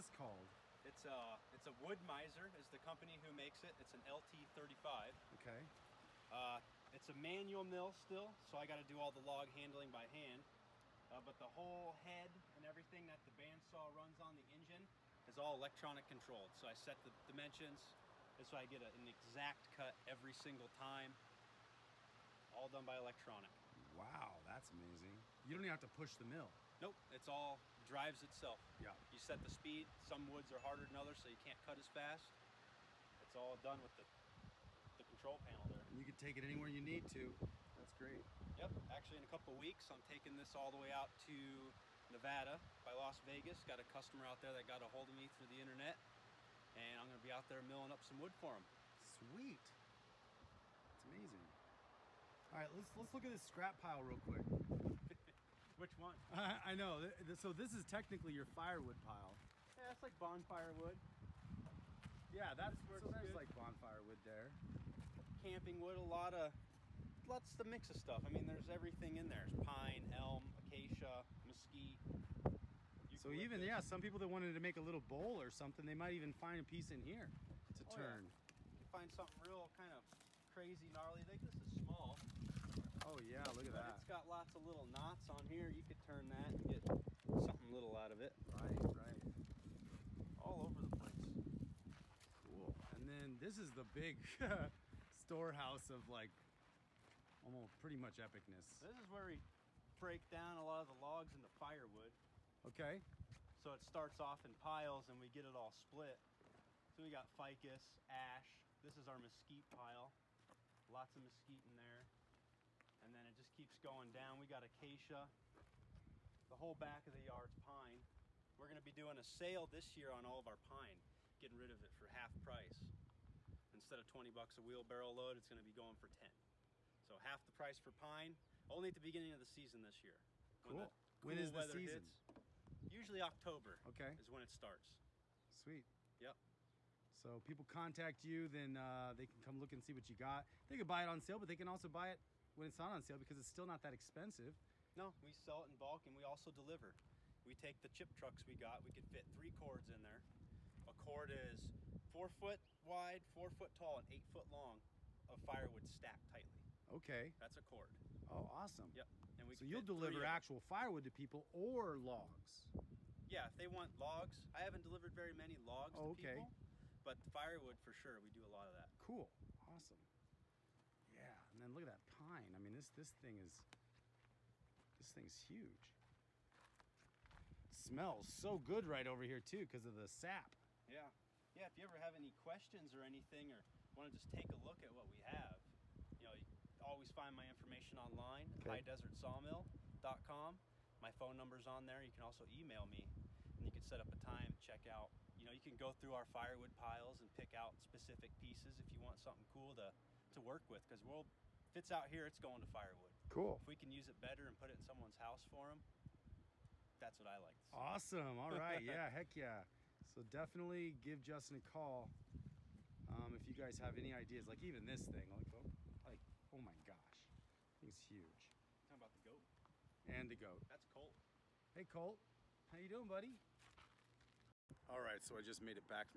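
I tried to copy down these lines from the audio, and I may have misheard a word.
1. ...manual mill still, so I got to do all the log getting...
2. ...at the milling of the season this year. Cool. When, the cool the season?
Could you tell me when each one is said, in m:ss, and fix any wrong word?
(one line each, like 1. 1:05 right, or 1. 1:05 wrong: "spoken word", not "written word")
1. 0:07 wrong: "handling", not "getting"
2. 2:08 wrong: "beginning", not "milling".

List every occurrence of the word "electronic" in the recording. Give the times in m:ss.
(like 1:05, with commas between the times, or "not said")
0:15, 0:22.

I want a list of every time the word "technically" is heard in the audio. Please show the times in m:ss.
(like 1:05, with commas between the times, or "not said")
0:57.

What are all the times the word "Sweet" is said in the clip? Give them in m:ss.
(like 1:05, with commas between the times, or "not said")
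0:48, 2:15.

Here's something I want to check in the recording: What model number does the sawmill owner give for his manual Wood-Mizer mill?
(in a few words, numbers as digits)
LT35.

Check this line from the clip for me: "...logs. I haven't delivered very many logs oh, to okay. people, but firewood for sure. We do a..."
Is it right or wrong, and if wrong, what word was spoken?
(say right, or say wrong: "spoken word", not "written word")
right.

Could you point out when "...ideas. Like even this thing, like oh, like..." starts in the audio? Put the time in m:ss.
3:34.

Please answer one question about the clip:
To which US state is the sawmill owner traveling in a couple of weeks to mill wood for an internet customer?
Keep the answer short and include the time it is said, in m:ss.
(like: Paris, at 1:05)
Nevada, at 0:42.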